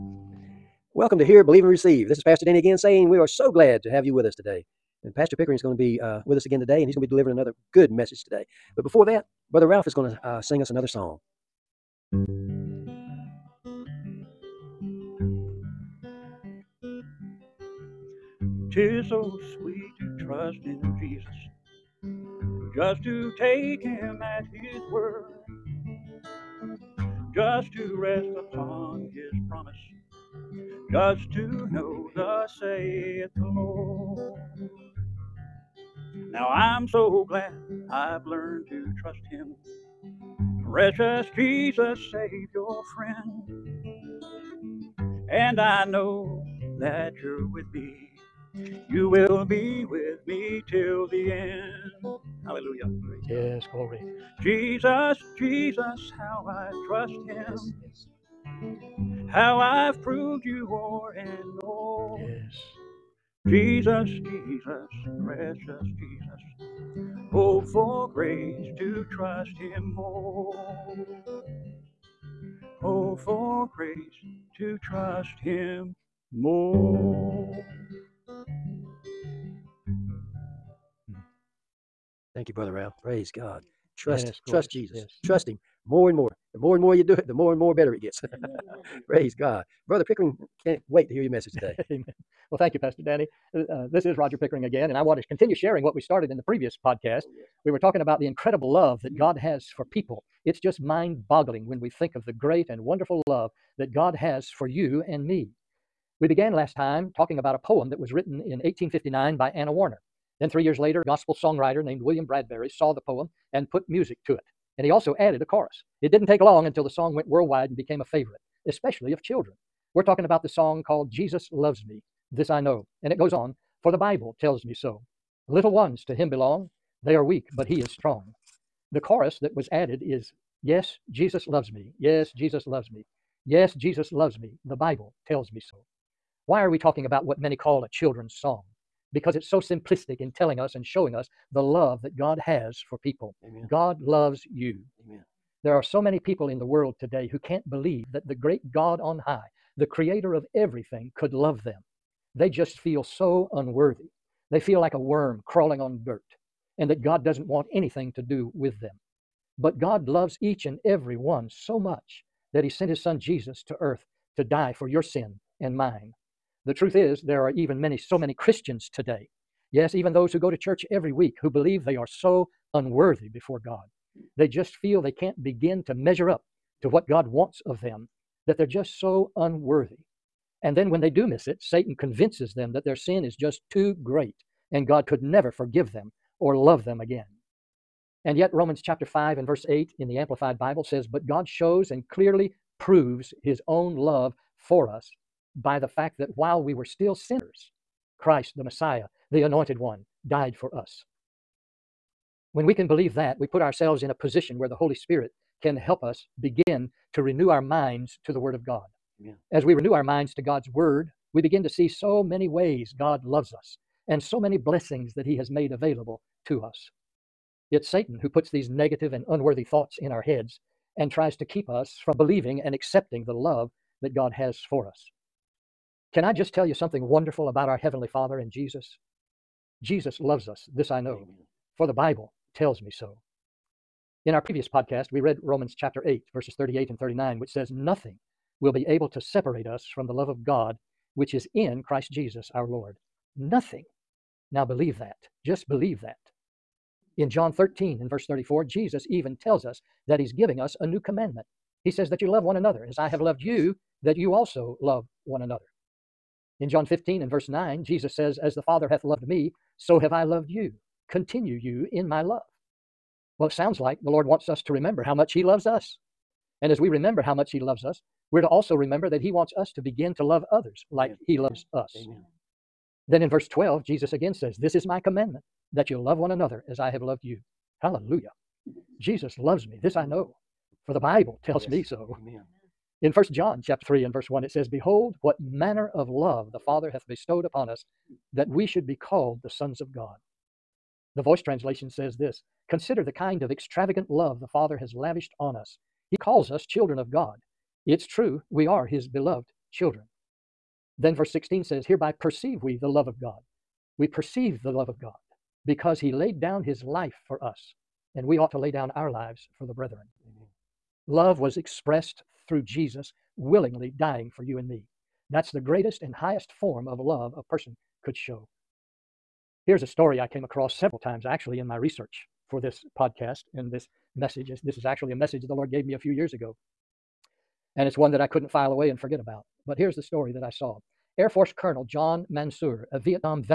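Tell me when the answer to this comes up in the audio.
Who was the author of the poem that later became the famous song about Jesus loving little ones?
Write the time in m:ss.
1:49.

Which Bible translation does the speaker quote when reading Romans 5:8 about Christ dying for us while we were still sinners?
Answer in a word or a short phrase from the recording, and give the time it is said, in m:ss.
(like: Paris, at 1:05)
Amplified Bible, at 3:10.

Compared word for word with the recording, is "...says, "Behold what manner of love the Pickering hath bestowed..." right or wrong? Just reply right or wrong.
wrong.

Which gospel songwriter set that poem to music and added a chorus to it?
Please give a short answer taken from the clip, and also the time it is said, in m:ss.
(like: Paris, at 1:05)
William Bradbury, at 1:52.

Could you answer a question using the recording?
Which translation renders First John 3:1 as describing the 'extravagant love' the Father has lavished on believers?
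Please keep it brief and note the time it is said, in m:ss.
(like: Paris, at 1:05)
The Voice, at 4:51.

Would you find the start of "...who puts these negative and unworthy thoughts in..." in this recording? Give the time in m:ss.
3:38.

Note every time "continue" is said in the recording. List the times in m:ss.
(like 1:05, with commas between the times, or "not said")
1:35, 4:21.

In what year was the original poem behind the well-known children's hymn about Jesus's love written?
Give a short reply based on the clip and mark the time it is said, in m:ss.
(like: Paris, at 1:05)
1859, at 1:48.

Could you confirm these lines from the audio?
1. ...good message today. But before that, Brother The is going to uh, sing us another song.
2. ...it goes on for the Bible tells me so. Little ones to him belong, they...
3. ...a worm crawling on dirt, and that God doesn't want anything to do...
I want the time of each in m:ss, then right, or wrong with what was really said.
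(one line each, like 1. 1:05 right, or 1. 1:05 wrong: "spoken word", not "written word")
1. 0:07 wrong: "Ralph", not "The"
2. 2:03 right
3. 2:34 right.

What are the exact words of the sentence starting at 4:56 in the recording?
He calls us children of God.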